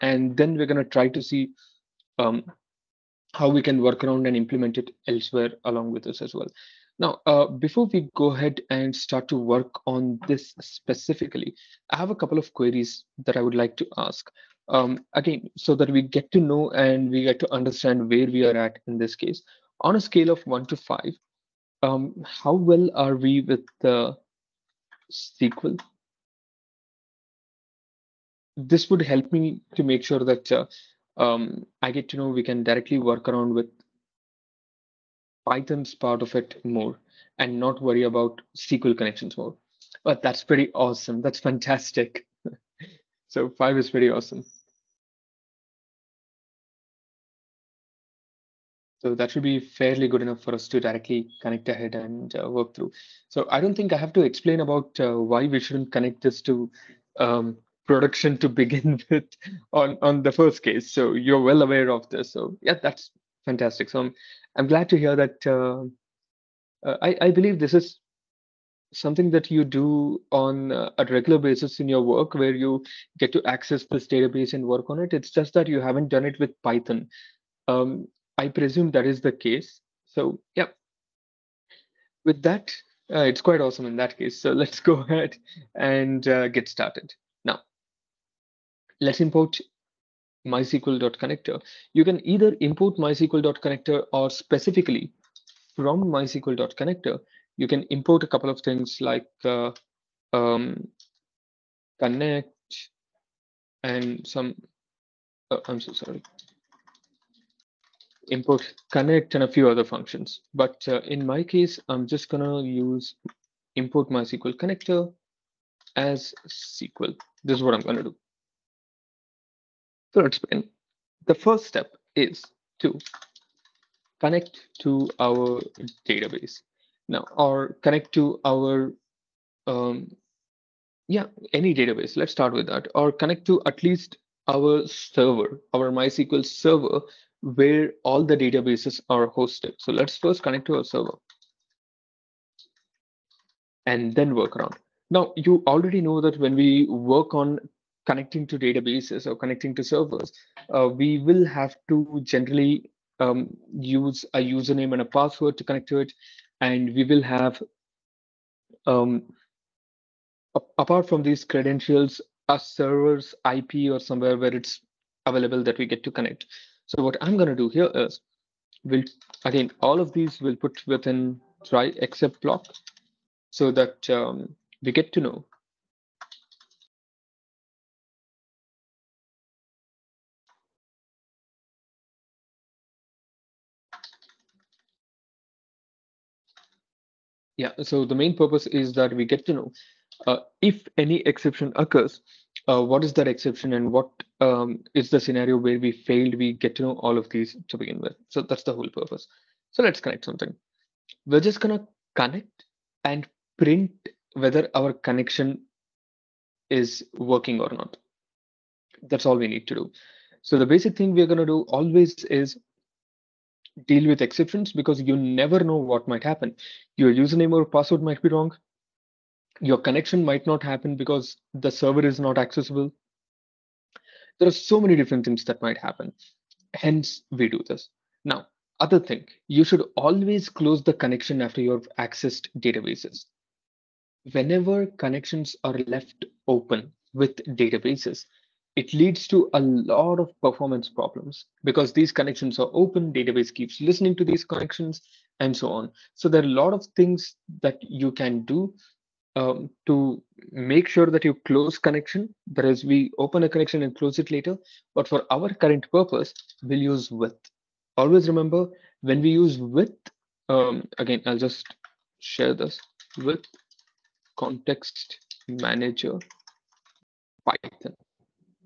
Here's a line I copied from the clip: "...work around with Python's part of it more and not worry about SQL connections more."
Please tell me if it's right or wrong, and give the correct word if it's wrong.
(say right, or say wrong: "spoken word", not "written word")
right.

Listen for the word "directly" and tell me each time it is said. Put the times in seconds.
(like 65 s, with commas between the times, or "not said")
32 s, 50 s.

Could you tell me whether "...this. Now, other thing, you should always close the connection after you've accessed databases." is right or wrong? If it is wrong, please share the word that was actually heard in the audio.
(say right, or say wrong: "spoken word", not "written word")
right.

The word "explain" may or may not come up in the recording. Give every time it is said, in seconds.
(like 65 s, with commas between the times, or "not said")
54 s.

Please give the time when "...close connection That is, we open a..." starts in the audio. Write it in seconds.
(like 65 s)
251 s.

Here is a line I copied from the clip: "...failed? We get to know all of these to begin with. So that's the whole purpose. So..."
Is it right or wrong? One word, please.
right.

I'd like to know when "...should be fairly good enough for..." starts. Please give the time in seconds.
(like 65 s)
49 s.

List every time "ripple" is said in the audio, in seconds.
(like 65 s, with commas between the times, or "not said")
not said.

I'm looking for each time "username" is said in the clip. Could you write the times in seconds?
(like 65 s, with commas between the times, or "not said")
154 s, 217 s.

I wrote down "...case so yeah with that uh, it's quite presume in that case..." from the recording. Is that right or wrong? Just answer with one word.
wrong.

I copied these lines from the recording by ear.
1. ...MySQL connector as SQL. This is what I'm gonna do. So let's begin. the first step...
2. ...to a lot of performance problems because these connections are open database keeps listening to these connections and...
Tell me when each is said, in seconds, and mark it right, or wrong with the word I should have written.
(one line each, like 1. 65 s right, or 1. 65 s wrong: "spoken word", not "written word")
1. 114 s right
2. 239 s right.